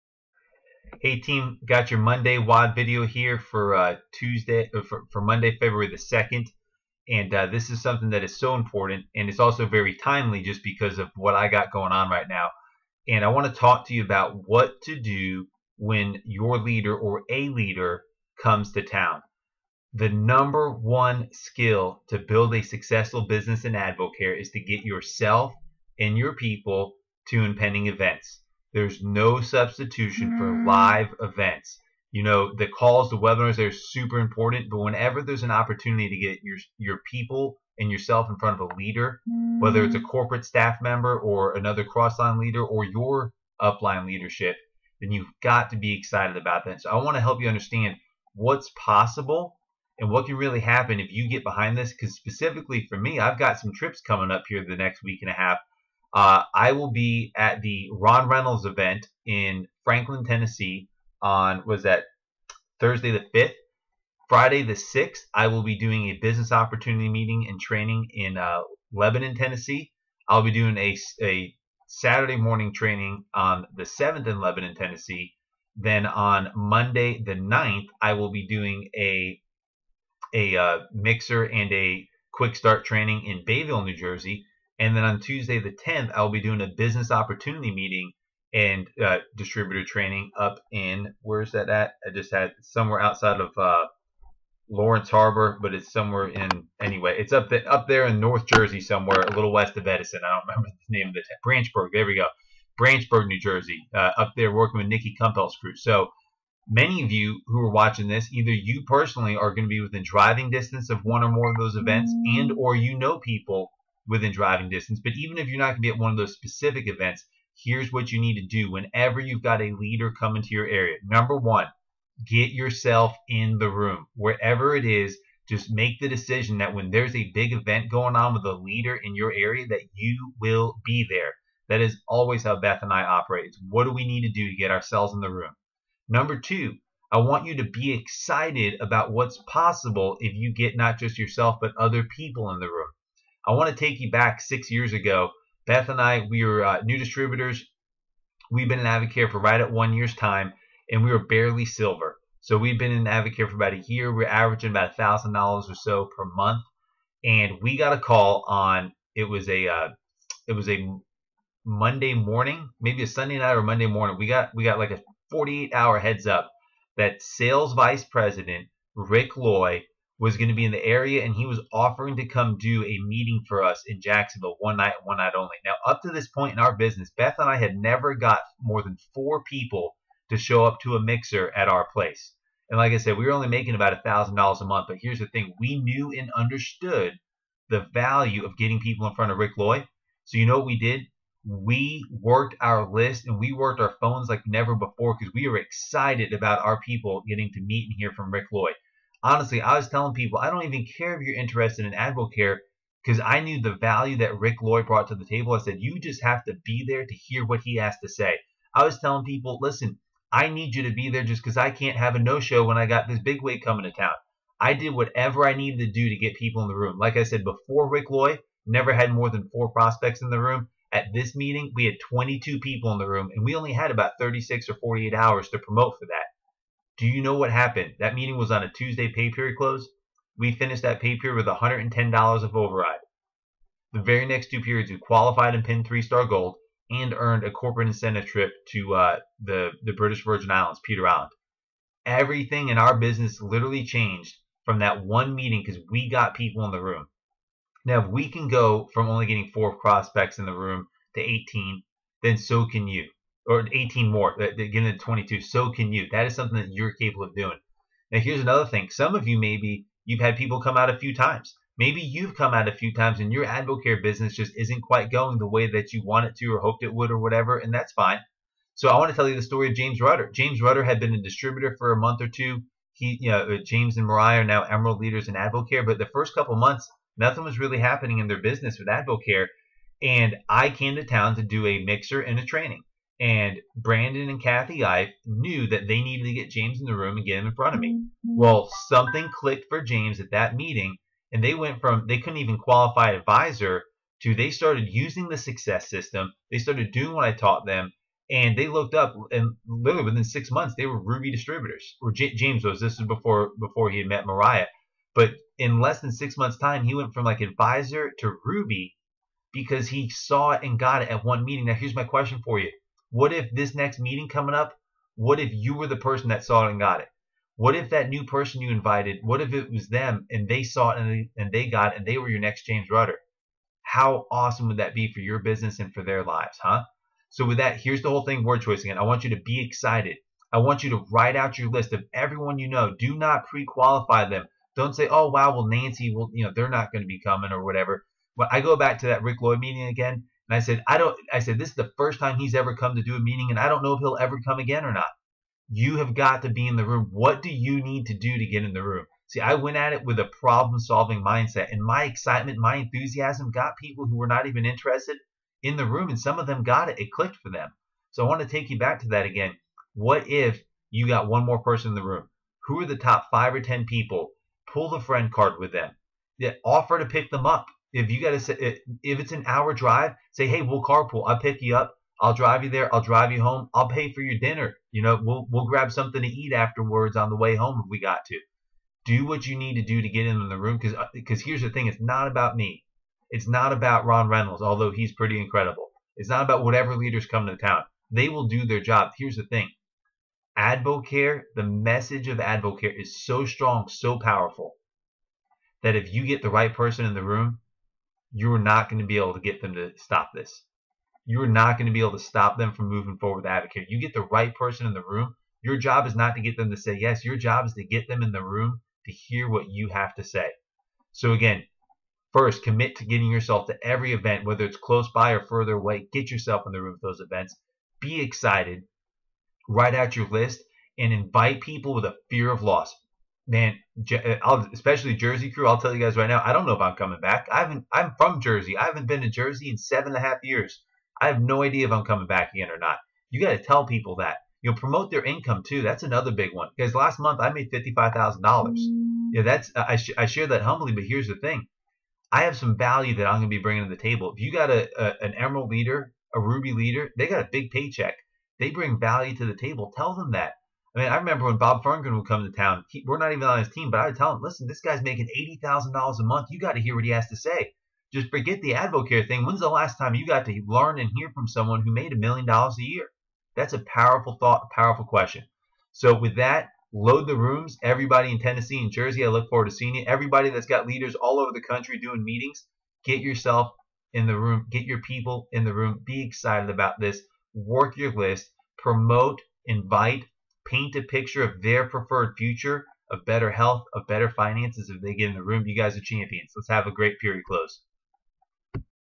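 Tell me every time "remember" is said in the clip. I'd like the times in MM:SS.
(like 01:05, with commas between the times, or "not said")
01:40, 07:31.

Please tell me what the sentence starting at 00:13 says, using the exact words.
And I want to talk to you about what to do when your leader or a leader comes to town.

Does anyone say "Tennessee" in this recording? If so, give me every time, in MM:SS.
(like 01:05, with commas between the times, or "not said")
01:00, 01:09, 01:14, 07:48.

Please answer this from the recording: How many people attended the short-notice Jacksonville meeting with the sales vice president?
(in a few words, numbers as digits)
22.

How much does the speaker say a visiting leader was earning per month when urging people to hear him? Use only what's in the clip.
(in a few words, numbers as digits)
$80,000.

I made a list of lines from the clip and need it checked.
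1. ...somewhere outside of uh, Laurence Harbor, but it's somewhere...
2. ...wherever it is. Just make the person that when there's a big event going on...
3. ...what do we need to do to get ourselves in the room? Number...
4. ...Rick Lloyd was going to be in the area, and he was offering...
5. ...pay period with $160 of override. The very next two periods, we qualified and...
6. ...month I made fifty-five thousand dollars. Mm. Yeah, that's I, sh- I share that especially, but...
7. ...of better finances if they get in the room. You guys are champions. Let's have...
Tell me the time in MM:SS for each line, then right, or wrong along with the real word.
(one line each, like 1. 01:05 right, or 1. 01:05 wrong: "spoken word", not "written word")
1. 01:32 right
2. 02:04 wrong: "decision", not "person"
3. 02:13 right
4. 02:48 right
5. 03:50 wrong: "110", not "160"
6. 07:17 wrong: "humbly", not "especially"
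7. 08:03 right.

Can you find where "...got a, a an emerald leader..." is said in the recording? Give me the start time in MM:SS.
07:24.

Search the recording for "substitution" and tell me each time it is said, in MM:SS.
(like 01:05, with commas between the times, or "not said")
00:29.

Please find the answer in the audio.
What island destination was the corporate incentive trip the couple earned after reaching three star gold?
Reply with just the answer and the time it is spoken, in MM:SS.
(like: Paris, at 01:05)
Peter Island, at 04:00.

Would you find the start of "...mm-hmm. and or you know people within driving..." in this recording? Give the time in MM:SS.
01:52.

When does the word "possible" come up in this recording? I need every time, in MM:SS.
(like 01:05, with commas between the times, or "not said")
00:48, 02:19.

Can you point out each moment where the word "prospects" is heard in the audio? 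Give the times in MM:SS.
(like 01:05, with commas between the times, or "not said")
03:39, 04:09.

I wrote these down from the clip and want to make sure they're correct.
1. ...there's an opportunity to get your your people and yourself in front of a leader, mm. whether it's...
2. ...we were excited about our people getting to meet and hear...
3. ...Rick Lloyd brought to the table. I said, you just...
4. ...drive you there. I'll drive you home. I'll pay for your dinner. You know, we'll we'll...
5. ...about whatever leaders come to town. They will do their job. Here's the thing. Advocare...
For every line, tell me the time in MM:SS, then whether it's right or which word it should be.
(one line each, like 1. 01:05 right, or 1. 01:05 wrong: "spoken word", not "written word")
1. 00:35 right
2. 03:15 right
3. 03:24 right
4. 06:12 right
5. 06:26 right.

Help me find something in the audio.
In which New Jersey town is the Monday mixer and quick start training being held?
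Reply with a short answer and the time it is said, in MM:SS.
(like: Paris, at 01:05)
Bayville, at 01:23.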